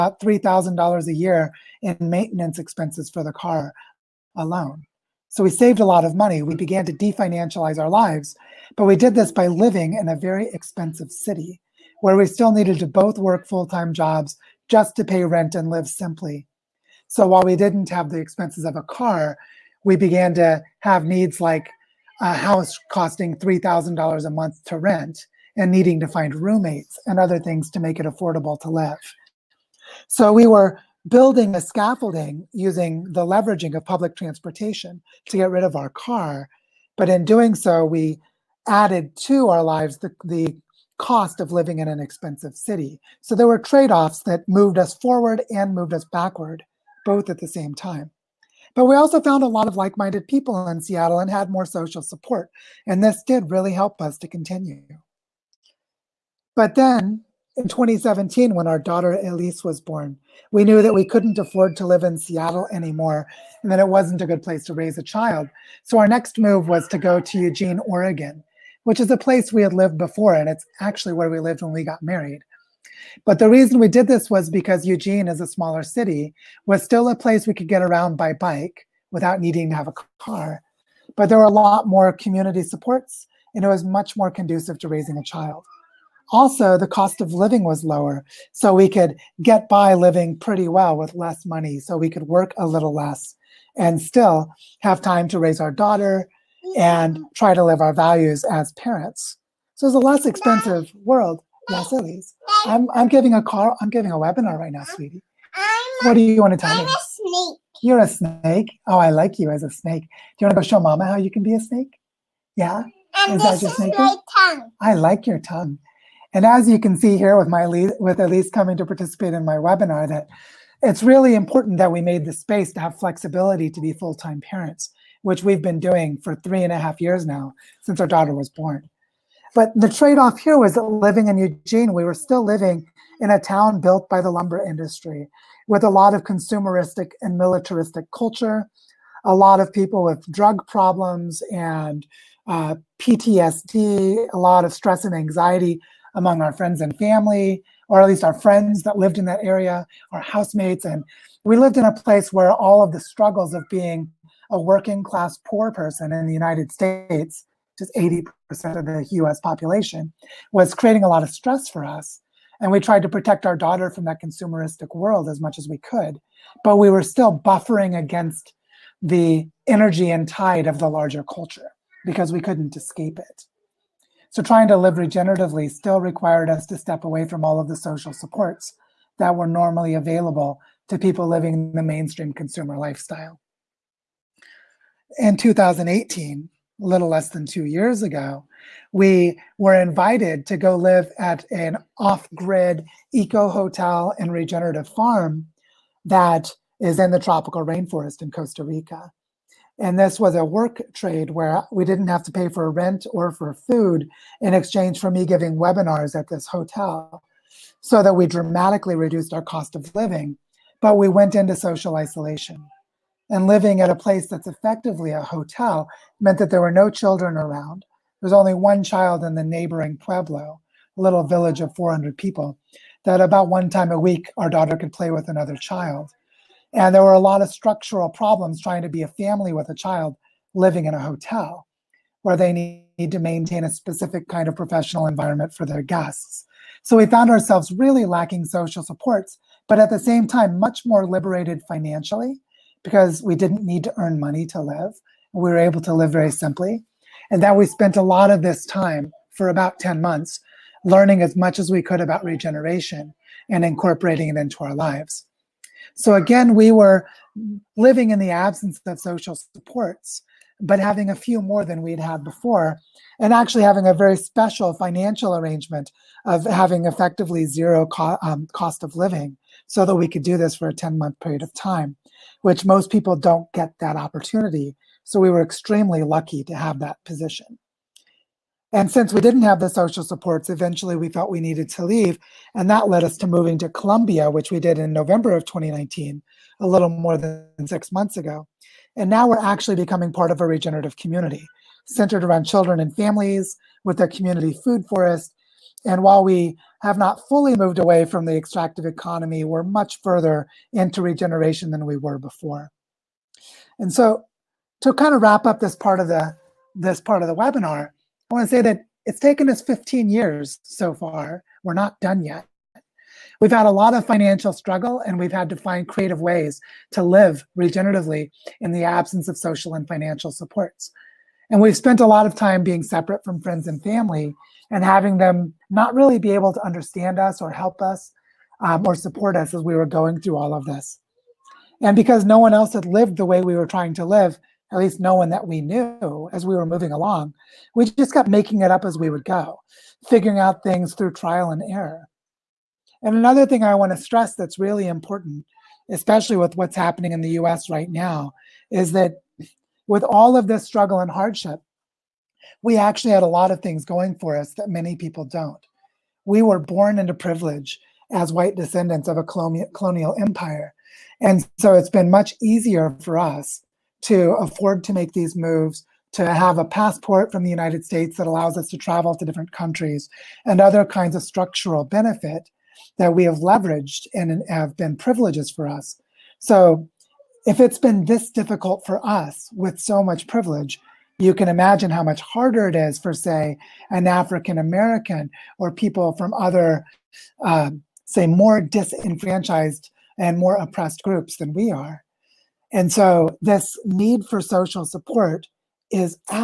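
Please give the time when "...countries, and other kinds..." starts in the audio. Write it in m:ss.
6:09.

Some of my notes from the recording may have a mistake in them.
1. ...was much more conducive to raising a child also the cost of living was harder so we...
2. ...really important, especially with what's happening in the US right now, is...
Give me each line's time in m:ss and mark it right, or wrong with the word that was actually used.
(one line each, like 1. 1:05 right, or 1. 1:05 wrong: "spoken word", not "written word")
1. 1:23 wrong: "lower", not "harder"
2. 5:44 right.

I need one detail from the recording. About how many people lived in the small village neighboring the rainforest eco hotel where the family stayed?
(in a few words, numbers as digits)
400.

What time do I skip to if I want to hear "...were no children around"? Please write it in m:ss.
3:36.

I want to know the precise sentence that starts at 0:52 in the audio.
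And this did really help us to continue.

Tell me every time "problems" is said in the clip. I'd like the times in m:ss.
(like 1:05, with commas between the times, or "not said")
2:20, 3:48.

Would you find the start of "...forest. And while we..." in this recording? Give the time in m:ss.
4:54.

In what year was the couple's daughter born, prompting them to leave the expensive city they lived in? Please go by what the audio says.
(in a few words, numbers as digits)
2017.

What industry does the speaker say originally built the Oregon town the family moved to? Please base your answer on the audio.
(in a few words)
lumber industry.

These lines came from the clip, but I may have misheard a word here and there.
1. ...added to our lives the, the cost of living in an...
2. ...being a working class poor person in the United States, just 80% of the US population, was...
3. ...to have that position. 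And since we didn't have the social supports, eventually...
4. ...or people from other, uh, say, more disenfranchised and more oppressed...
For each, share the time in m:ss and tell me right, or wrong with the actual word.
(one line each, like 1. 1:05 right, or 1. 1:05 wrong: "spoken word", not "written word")
1. 0:38 right
2. 2:33 right
3. 4:36 right
4. 6:25 right.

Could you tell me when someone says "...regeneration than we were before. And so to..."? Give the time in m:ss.
5:01.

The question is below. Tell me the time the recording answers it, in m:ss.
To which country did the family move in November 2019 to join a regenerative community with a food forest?
4:43.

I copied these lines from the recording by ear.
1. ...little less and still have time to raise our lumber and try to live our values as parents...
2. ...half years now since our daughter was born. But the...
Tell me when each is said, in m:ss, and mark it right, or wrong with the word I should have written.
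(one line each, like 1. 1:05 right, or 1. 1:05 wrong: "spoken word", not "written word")
1. 1:32 wrong: "daughter", not "lumber"
2. 2:06 right.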